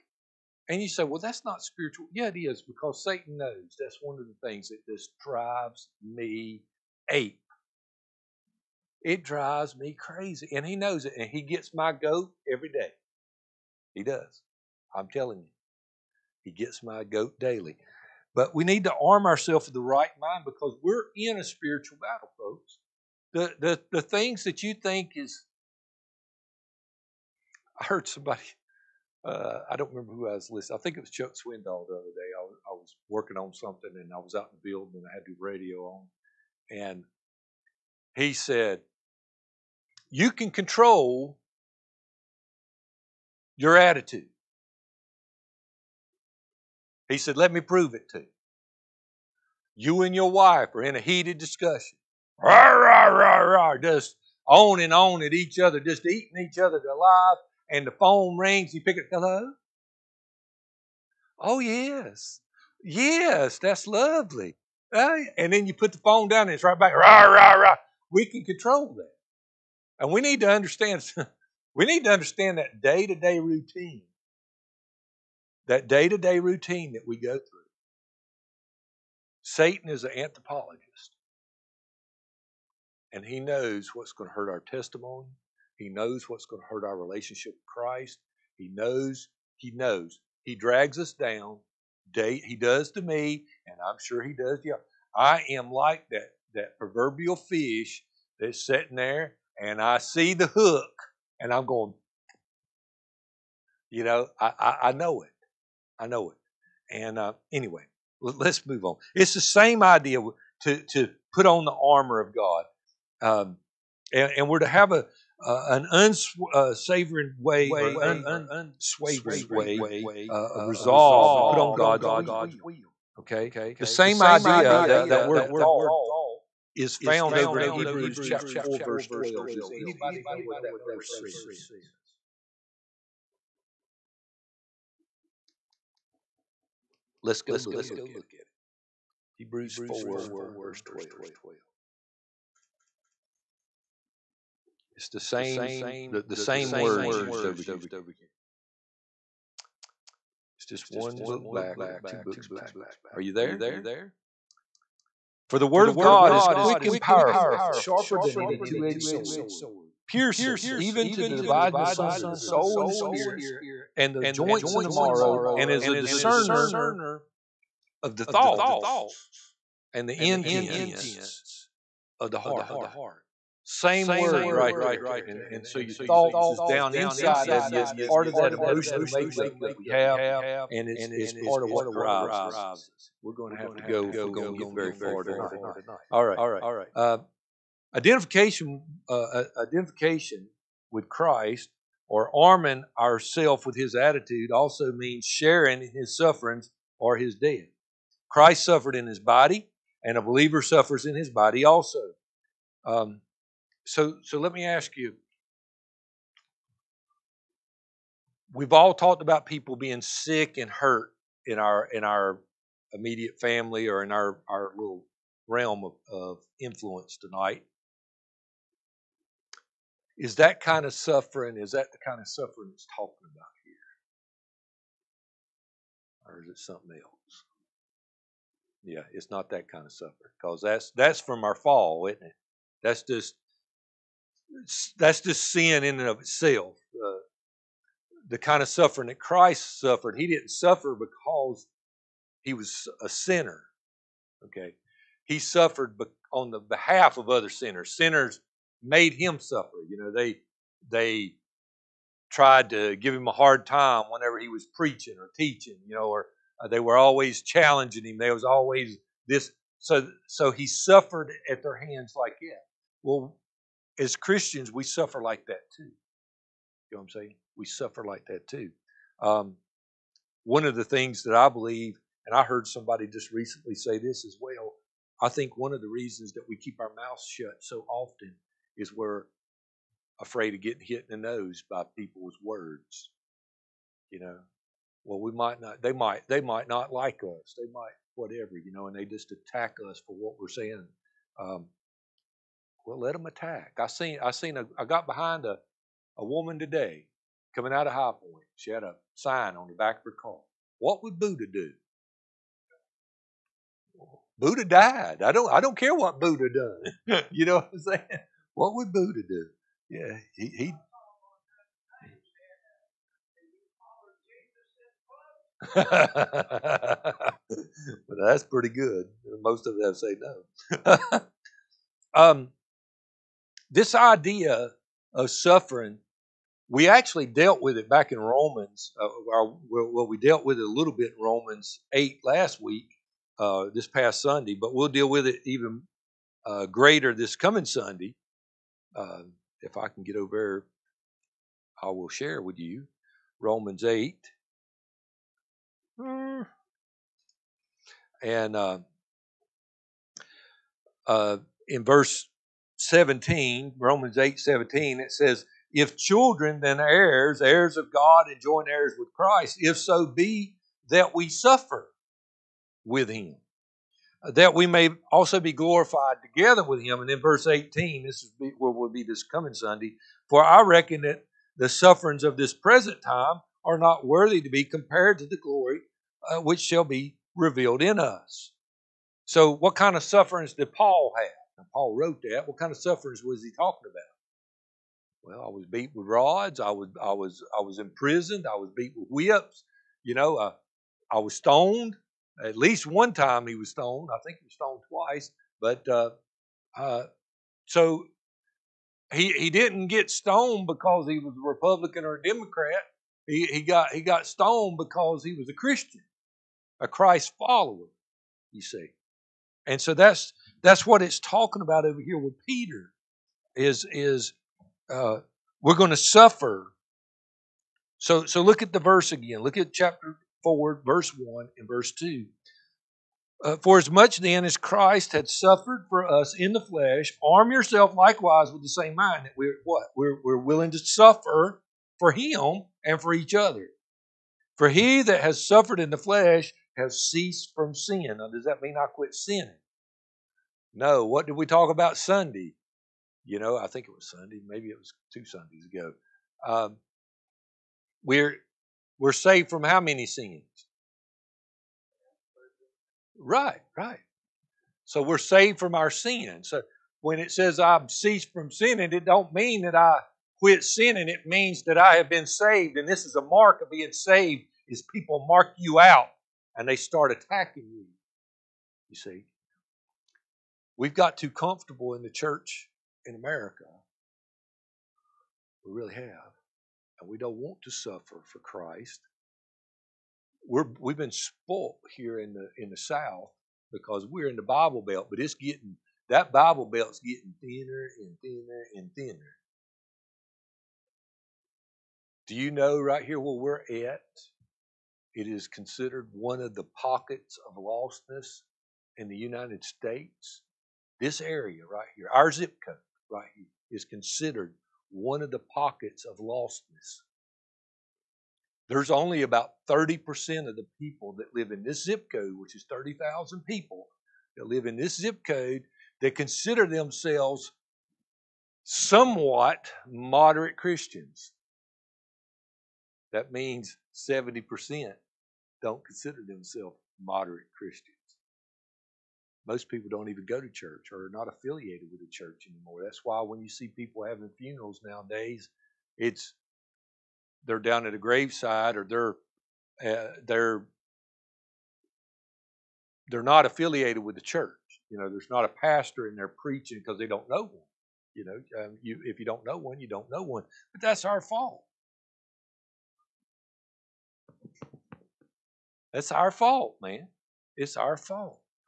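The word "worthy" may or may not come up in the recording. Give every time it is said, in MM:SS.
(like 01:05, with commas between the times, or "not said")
06:14.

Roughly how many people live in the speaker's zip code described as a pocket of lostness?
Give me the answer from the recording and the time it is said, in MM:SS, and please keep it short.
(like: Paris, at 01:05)
30,000, at 08:32.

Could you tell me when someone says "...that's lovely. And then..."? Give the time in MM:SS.
01:03.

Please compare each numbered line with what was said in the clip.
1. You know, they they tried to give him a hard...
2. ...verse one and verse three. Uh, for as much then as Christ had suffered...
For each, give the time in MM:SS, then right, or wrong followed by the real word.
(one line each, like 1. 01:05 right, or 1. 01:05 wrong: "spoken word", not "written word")
1. 04:09 right
2. 07:00 wrong: "two", not "three".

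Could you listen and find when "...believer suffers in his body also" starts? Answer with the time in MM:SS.
03:20.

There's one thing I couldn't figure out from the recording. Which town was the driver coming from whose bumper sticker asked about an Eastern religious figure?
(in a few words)
High Point.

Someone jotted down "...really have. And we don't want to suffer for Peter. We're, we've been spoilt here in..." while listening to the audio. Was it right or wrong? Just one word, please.
wrong.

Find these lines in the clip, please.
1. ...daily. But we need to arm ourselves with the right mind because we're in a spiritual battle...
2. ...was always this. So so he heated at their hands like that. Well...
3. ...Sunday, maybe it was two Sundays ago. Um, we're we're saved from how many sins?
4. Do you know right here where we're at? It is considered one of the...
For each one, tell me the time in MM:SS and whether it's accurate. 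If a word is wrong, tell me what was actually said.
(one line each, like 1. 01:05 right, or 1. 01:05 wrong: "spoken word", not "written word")
1. 00:17 right
2. 04:18 wrong: "suffered", not "heated"
3. 07:24 right
4. 08:12 right.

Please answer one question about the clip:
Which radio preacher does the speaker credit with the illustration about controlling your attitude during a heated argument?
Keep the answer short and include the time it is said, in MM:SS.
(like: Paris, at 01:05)
Chuck Swindoll, at 00:31.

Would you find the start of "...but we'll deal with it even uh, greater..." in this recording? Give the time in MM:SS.
05:34.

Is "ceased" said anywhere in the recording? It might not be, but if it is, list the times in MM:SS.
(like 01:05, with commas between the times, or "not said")
07:17, 07:37.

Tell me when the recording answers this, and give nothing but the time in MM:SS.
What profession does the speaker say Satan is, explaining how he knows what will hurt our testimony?
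01:20.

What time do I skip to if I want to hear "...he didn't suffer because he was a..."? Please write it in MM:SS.
04:00.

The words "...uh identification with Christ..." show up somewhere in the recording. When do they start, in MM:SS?
03:09.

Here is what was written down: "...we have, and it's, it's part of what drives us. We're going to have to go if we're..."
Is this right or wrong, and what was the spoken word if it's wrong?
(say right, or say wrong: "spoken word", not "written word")
right.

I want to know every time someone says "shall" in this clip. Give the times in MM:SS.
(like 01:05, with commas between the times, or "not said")
06:16.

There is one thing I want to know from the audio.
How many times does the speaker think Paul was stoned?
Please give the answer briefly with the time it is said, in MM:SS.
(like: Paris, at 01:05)
twice, at 06:34.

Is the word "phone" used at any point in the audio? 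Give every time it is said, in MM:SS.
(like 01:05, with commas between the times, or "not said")
00:57, 01:05.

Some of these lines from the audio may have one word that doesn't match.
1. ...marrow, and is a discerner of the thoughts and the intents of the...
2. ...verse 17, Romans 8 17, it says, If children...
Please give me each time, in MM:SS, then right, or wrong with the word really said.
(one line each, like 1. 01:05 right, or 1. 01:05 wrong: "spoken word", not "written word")
1. 02:44 right
2. 05:51 right.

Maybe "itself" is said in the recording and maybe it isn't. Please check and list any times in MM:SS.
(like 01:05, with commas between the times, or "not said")
03:56.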